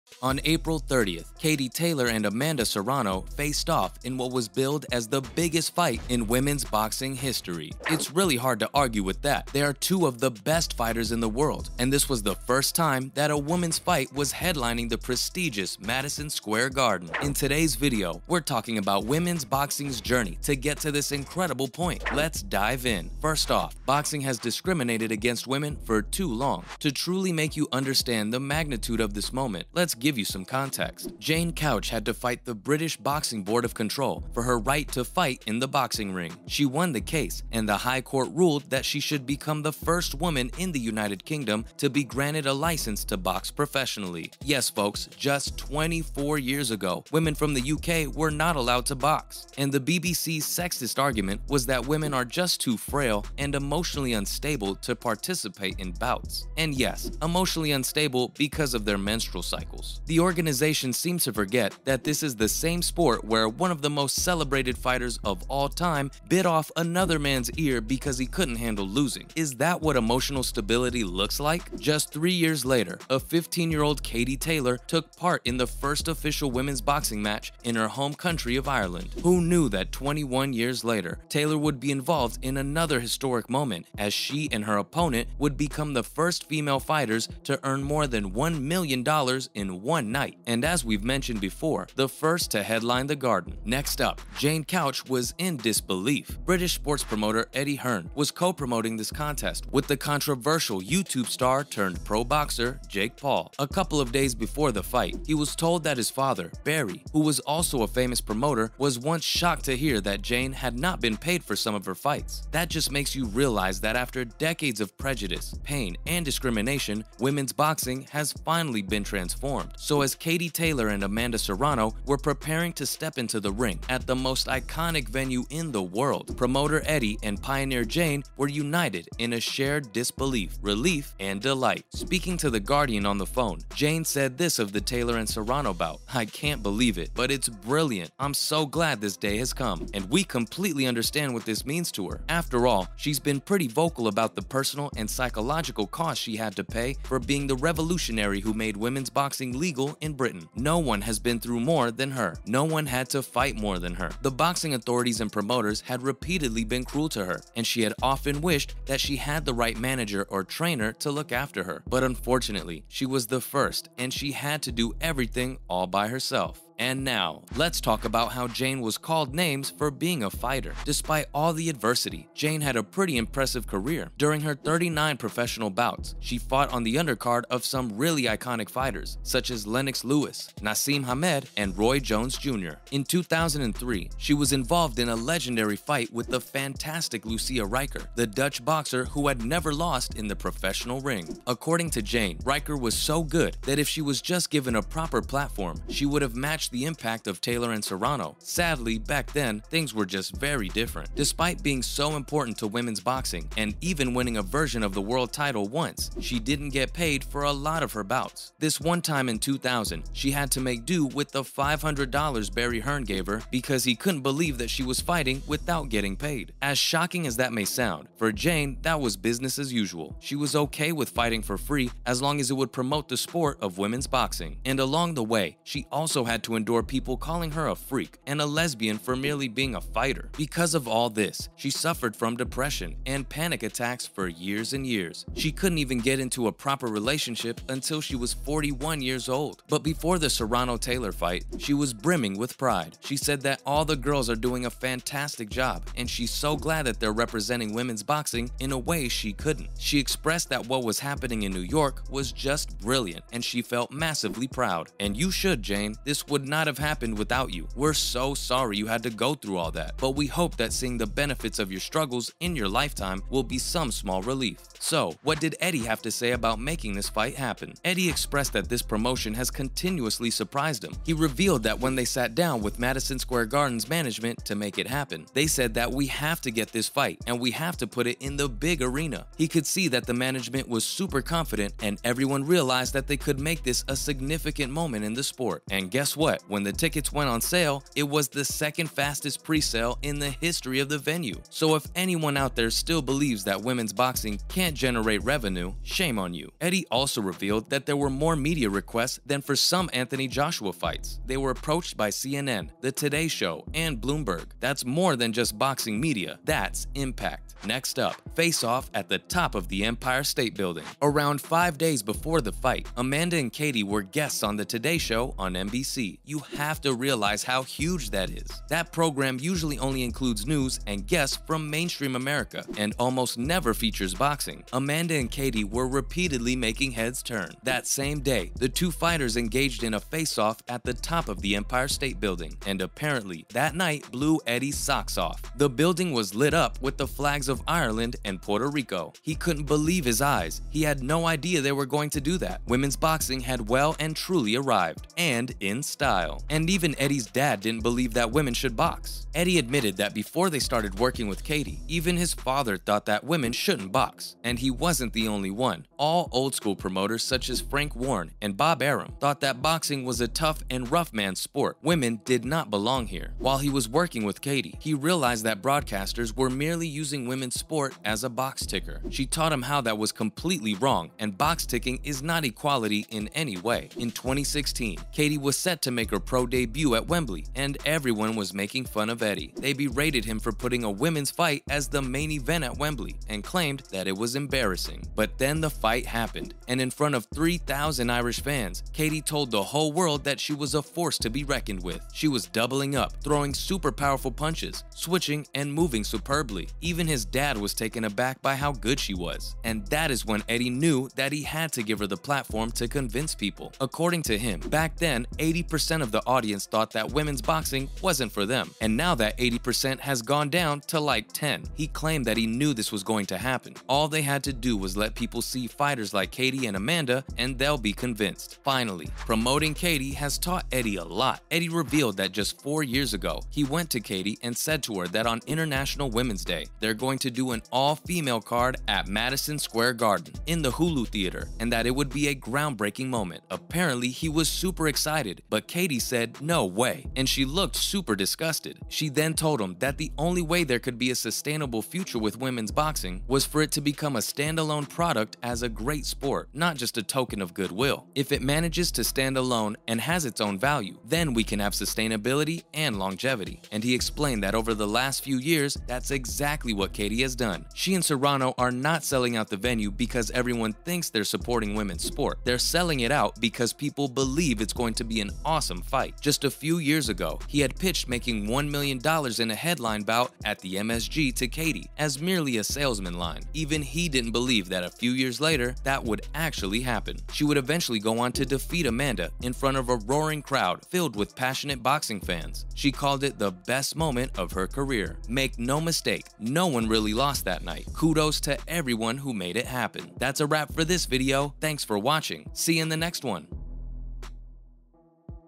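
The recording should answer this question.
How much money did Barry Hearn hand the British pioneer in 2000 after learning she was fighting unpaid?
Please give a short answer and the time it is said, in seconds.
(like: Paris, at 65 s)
$500, at 211 s.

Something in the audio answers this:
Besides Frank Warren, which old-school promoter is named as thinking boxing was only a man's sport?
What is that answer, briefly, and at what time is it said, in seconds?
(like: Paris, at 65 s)
Bob Arum, at 358 s.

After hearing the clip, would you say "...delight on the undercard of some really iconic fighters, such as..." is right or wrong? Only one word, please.
wrong.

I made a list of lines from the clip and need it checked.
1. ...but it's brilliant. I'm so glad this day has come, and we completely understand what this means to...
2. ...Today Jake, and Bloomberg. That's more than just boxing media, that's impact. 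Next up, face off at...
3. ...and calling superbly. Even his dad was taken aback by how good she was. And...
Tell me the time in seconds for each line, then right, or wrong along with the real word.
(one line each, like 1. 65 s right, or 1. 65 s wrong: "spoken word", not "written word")
1. 137 s right
2. 302 s wrong: "Show", not "Jake"
3. 395 s wrong: "moving", not "calling".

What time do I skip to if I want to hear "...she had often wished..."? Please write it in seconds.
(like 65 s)
157 s.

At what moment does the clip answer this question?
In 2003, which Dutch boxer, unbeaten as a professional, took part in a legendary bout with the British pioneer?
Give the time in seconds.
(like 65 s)
187 s.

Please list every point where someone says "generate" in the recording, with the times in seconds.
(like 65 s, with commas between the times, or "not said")
294 s.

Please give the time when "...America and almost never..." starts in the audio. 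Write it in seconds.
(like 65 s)
322 s.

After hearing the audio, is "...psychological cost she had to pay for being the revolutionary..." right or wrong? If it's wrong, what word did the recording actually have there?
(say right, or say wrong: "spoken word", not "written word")
right.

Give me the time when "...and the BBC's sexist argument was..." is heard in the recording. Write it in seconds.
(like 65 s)
49 s.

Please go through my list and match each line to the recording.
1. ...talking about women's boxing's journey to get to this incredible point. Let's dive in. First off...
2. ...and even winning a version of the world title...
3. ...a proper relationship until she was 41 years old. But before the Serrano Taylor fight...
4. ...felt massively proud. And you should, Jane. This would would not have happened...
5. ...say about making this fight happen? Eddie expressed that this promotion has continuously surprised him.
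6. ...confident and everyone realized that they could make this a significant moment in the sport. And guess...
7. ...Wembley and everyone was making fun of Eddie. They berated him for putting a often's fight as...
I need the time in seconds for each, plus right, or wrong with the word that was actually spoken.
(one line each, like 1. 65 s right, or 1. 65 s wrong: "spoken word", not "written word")
1. 18 s right
2. 203 s right
3. 236 s right
4. 253 s right
5. 266 s right
6. 281 s right
7. 377 s wrong: "women", not "often".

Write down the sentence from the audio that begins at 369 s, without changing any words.
She taught him how that was completely wrong and box ticking is not equality in any way.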